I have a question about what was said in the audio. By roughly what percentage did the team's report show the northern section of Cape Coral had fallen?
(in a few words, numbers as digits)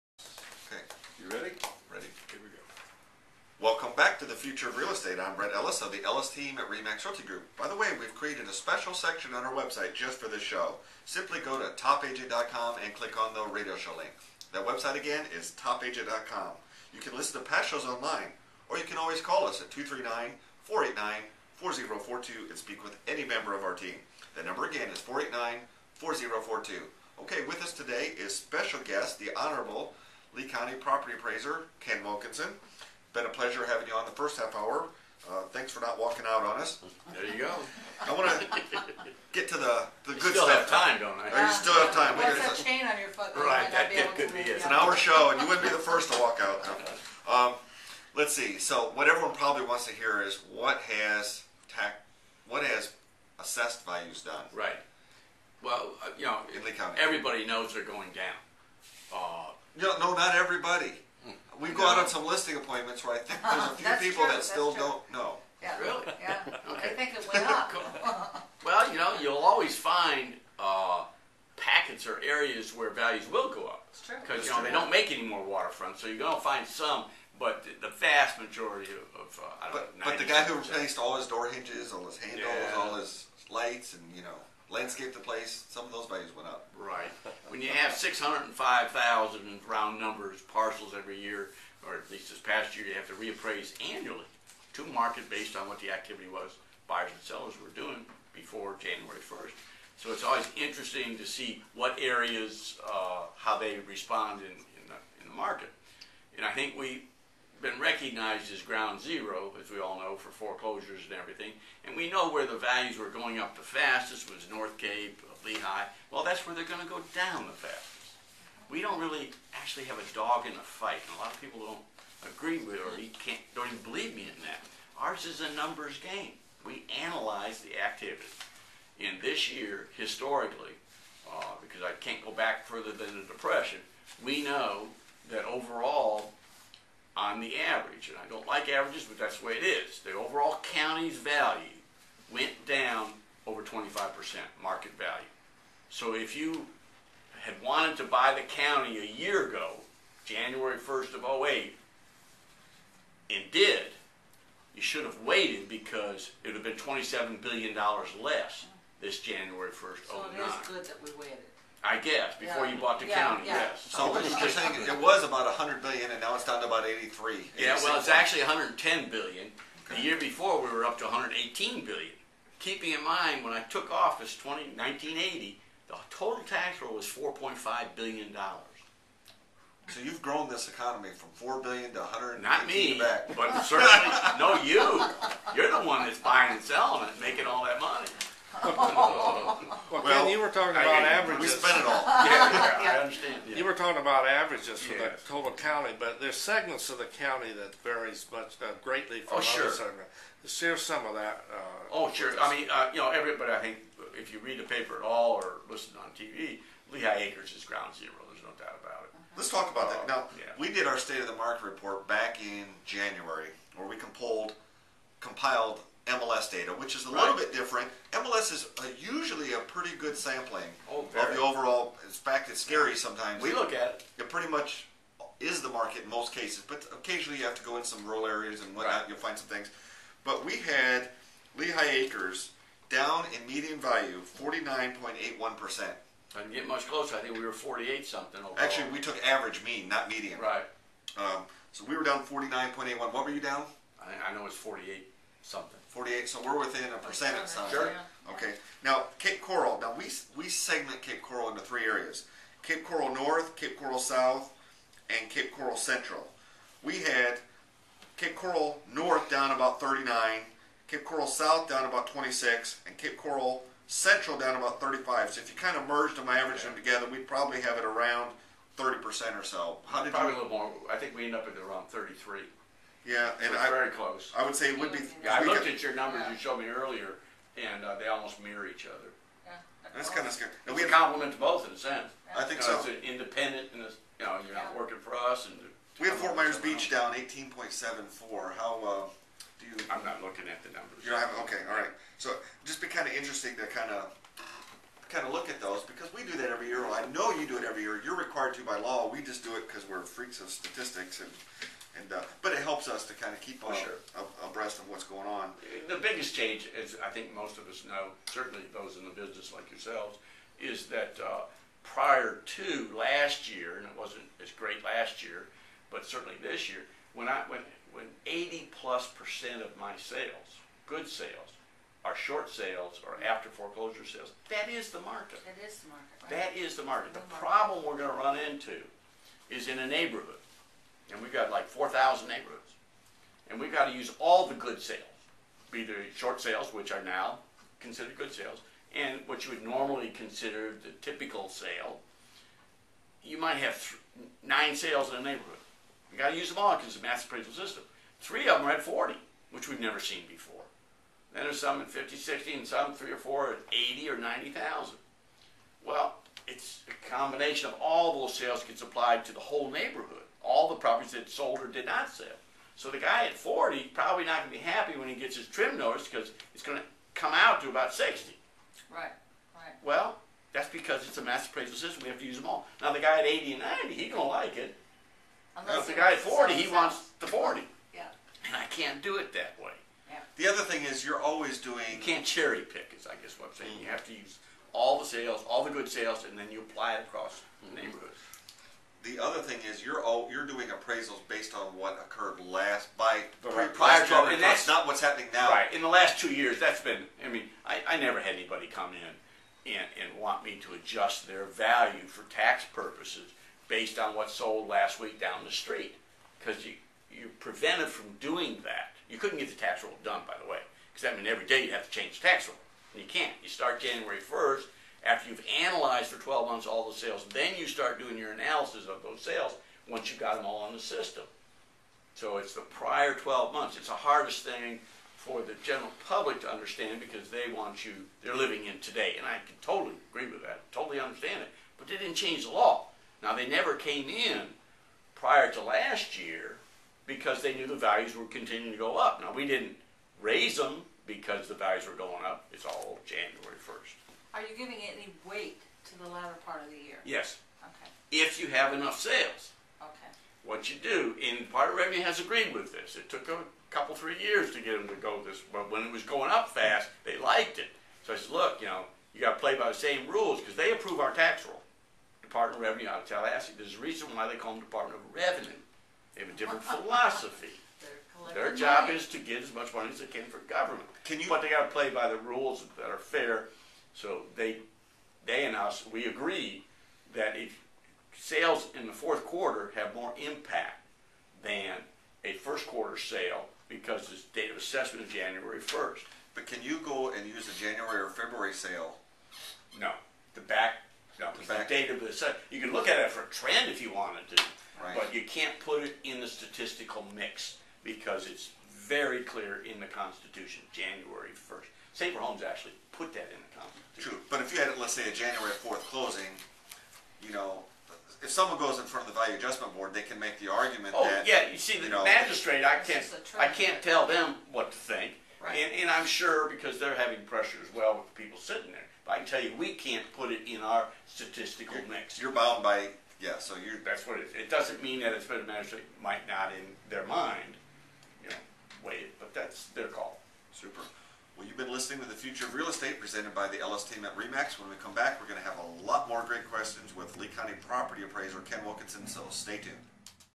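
39%.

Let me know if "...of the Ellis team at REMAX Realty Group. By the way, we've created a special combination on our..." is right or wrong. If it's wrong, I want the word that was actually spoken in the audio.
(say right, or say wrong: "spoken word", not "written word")
wrong: "section", not "combination".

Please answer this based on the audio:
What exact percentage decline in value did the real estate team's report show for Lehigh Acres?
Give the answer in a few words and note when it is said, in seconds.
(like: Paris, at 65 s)
49.81%, at 234 s.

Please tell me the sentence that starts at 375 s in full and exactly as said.
Unless now, if the guy at 40, he wants the 40.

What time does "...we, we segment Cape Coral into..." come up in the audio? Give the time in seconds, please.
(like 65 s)
249 s.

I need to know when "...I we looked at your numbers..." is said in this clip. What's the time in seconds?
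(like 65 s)
275 s.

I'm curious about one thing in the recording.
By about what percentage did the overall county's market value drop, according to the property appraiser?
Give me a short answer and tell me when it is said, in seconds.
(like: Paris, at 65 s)
25%, at 143 s.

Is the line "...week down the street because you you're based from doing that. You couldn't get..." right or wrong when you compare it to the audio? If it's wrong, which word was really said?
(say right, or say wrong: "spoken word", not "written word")
wrong: "prevented", not "based".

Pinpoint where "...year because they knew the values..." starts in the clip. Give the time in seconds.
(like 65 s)
436 s.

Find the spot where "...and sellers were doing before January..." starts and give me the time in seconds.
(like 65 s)
97 s.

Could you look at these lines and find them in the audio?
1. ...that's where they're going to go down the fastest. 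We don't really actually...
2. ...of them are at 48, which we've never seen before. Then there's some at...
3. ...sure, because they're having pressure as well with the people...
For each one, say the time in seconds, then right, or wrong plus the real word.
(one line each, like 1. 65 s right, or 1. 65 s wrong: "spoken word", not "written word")
1. 116 s right
2. 348 s wrong: "40", not "48"
3. 516 s right.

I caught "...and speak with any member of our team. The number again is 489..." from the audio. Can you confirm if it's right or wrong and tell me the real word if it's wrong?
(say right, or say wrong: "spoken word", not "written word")
right.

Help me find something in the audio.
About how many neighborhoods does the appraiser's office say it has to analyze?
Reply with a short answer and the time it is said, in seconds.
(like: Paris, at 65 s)
4,000, at 331 s.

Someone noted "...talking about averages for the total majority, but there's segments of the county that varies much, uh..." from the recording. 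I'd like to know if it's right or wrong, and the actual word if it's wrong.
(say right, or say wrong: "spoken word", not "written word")
wrong: "county", not "majority".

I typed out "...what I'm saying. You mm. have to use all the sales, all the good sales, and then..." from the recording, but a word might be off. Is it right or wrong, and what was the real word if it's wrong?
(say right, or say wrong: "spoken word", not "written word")
right.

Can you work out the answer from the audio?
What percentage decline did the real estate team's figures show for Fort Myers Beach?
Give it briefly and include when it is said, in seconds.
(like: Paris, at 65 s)
18.74%, at 287 s.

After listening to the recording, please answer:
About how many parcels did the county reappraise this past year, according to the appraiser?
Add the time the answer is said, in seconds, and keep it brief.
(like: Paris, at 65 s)
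605,000, at 87 s.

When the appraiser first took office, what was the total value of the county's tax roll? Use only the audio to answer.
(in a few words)
4.5 billion dollars.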